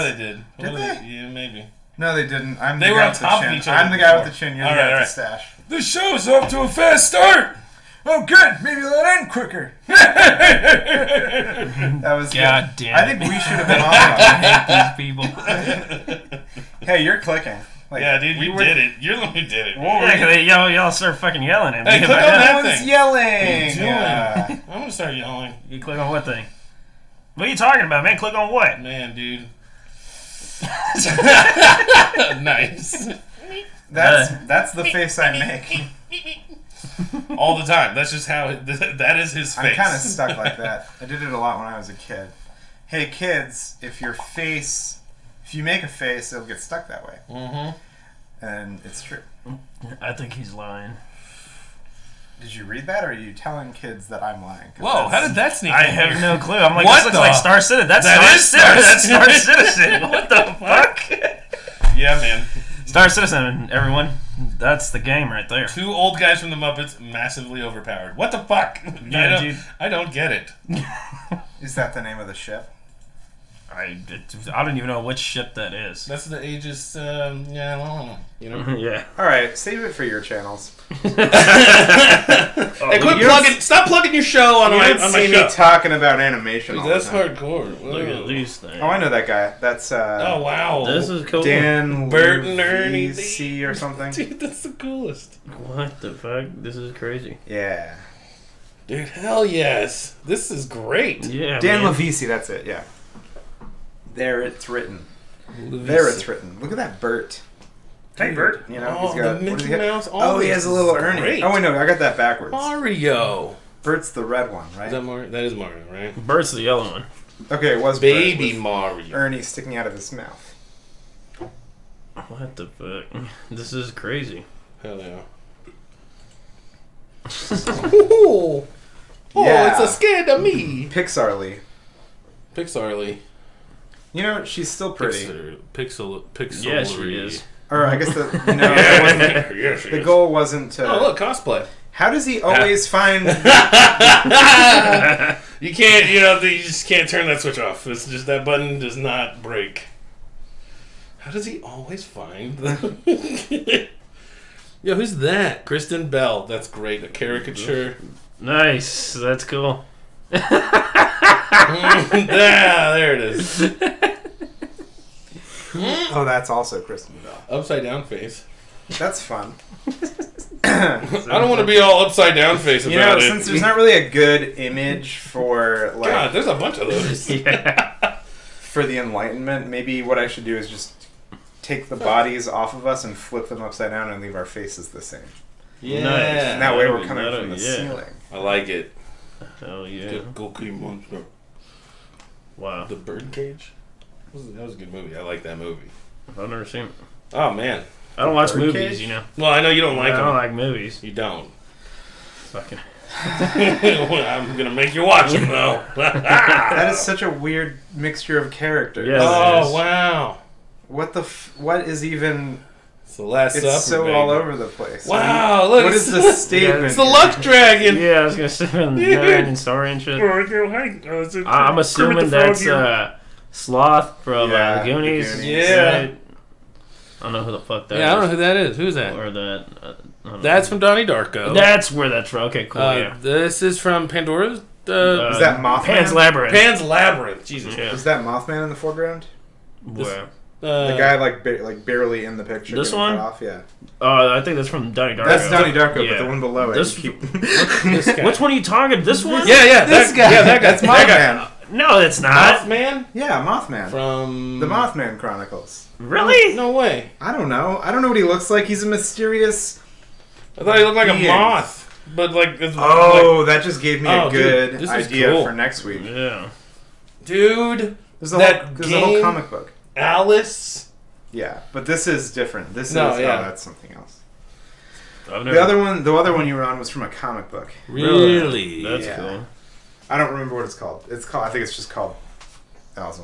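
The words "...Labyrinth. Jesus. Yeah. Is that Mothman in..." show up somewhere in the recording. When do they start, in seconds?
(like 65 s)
236 s.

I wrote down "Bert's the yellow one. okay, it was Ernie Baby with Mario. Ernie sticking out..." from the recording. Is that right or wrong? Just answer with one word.
wrong.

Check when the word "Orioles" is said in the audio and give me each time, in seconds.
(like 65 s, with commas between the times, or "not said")
not said.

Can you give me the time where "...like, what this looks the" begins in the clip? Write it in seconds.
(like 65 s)
56 s.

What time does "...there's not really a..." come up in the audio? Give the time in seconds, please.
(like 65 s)
173 s.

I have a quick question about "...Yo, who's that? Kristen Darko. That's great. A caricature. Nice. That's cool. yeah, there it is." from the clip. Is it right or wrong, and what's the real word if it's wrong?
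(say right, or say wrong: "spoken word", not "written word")
wrong: "Bell", not "Darko".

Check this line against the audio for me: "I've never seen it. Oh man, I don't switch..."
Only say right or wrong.
wrong.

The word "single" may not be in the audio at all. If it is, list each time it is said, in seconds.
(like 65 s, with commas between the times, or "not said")
not said.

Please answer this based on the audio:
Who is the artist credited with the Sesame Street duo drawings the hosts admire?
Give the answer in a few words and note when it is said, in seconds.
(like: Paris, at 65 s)
Dan LuVisi, at 101 s.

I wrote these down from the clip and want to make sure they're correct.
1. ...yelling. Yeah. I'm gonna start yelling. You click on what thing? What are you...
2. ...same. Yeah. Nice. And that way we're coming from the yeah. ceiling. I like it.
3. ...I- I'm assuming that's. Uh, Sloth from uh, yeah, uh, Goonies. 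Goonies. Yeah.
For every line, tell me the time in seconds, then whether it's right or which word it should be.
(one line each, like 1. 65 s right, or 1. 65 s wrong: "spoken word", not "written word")
1. 22 s right
2. 184 s right
3. 221 s right.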